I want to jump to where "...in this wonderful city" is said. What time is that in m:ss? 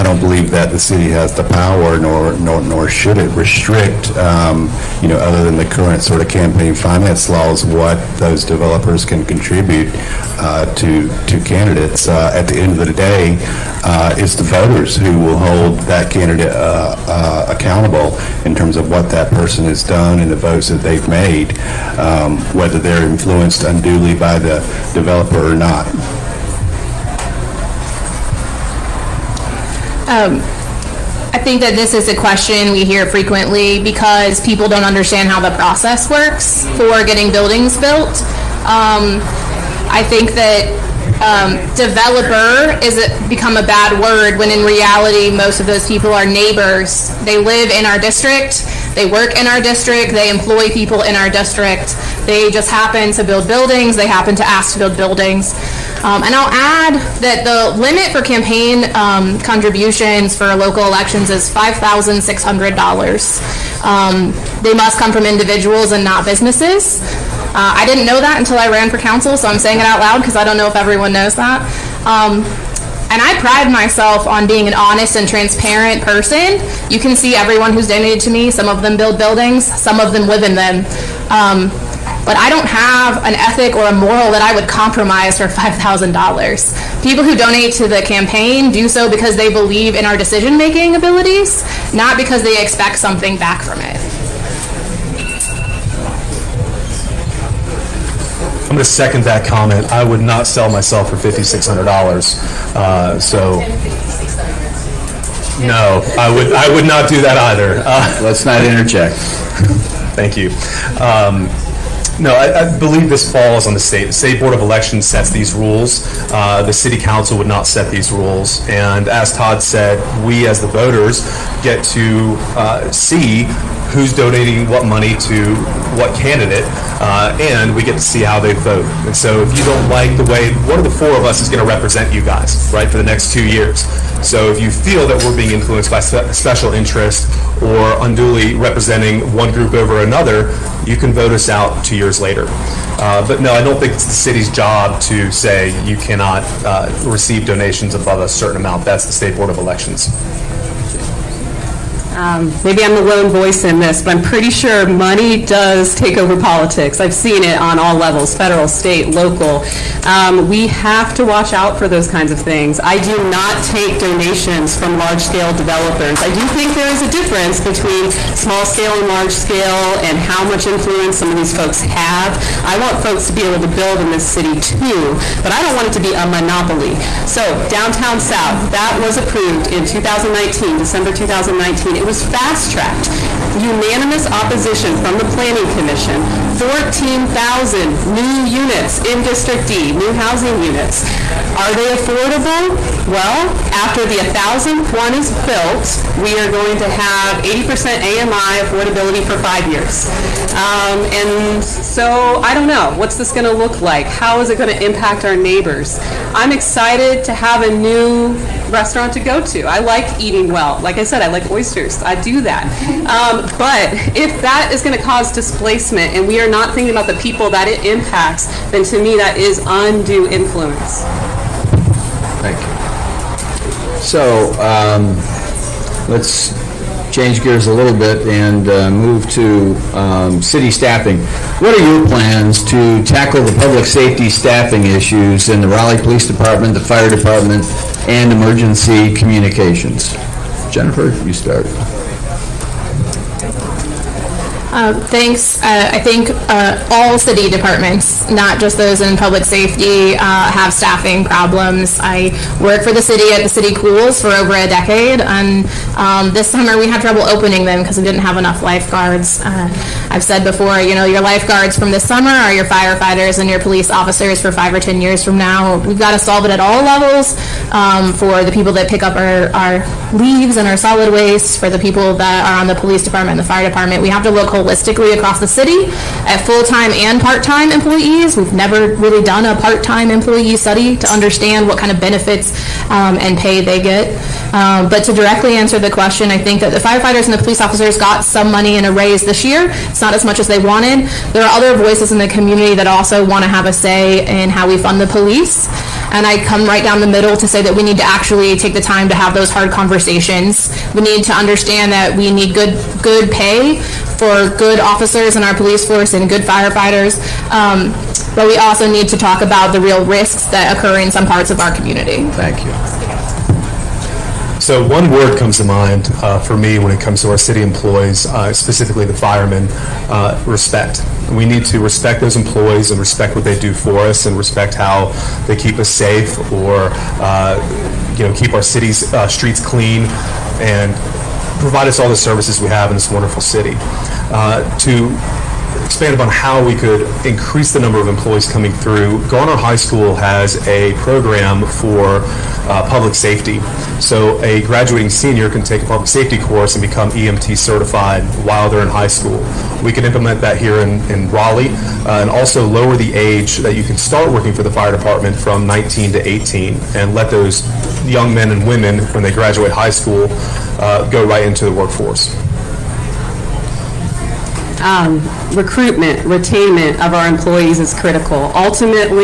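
5:32.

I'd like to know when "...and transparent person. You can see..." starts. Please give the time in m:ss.
1:15.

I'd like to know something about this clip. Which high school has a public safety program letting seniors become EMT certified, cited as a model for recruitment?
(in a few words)
Garner High School.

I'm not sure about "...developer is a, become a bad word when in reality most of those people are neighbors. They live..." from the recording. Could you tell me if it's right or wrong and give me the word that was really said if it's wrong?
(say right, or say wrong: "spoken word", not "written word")
right.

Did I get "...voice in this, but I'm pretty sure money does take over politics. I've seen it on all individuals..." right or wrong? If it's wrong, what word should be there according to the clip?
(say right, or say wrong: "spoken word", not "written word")
wrong: "levels", not "individuals".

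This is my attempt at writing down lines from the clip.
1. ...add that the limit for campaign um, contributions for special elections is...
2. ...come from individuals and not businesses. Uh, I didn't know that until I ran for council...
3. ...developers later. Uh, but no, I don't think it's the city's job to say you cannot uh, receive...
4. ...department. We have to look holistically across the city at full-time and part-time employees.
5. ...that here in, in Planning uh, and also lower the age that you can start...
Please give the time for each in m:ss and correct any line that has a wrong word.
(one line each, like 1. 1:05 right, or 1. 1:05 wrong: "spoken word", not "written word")
1. 0:56 wrong: "local", not "special"
2. 1:04 right
3. 2:21 wrong: "years", not "developers"
4. 4:33 right
5. 5:50 wrong: "Raleigh", not "Planning".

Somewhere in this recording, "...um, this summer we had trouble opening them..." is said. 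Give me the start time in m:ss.
4:15.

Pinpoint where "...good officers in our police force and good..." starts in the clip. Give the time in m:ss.
5:04.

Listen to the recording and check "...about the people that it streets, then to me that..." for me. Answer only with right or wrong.
wrong.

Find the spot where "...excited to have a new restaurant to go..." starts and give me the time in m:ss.
3:26.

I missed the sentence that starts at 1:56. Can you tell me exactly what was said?
Uh, the city council would not set these rules.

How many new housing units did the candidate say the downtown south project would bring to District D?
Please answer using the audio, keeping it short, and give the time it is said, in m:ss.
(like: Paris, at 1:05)
14,000, at 3:06.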